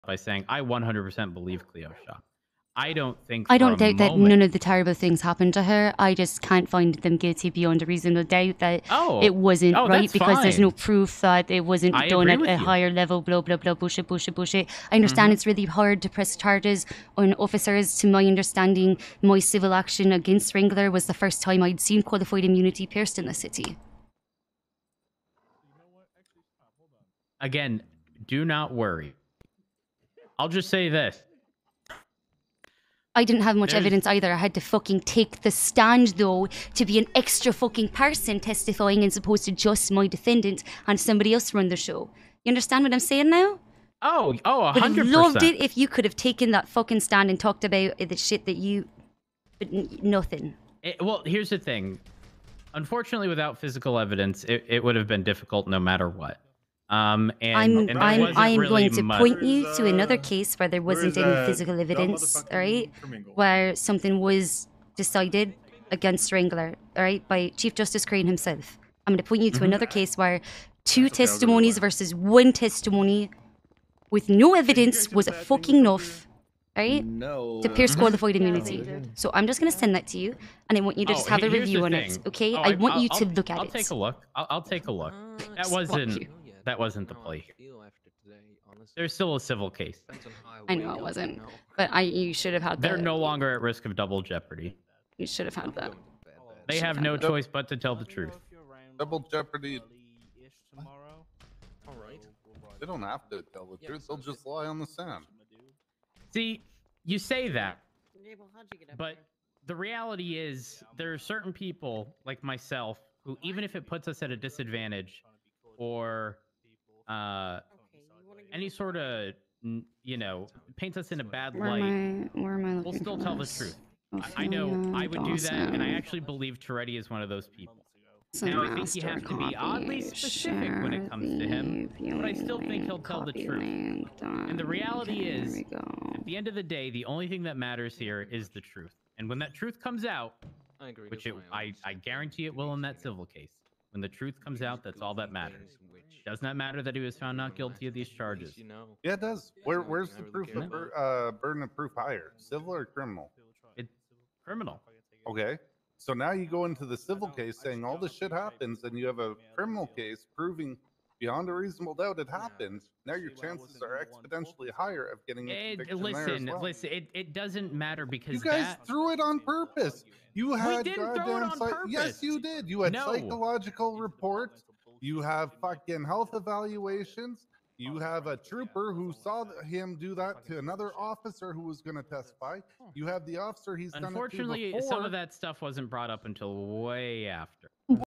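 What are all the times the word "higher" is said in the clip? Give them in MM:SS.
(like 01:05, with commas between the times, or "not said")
00:12, 02:31, 02:44.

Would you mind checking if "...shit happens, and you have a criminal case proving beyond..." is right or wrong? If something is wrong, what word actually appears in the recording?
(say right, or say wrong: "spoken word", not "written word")
right.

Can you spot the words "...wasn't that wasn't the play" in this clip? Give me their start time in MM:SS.
01:25.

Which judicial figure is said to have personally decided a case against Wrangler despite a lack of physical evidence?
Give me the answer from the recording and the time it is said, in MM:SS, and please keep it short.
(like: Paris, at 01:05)
Chief Justice Crane, at 01:07.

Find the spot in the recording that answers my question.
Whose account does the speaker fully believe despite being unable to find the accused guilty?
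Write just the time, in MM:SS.
00:01.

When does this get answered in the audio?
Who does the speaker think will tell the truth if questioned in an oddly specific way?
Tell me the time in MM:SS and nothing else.
02:06.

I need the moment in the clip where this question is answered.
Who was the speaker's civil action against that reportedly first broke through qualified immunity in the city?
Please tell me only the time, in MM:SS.
00:20.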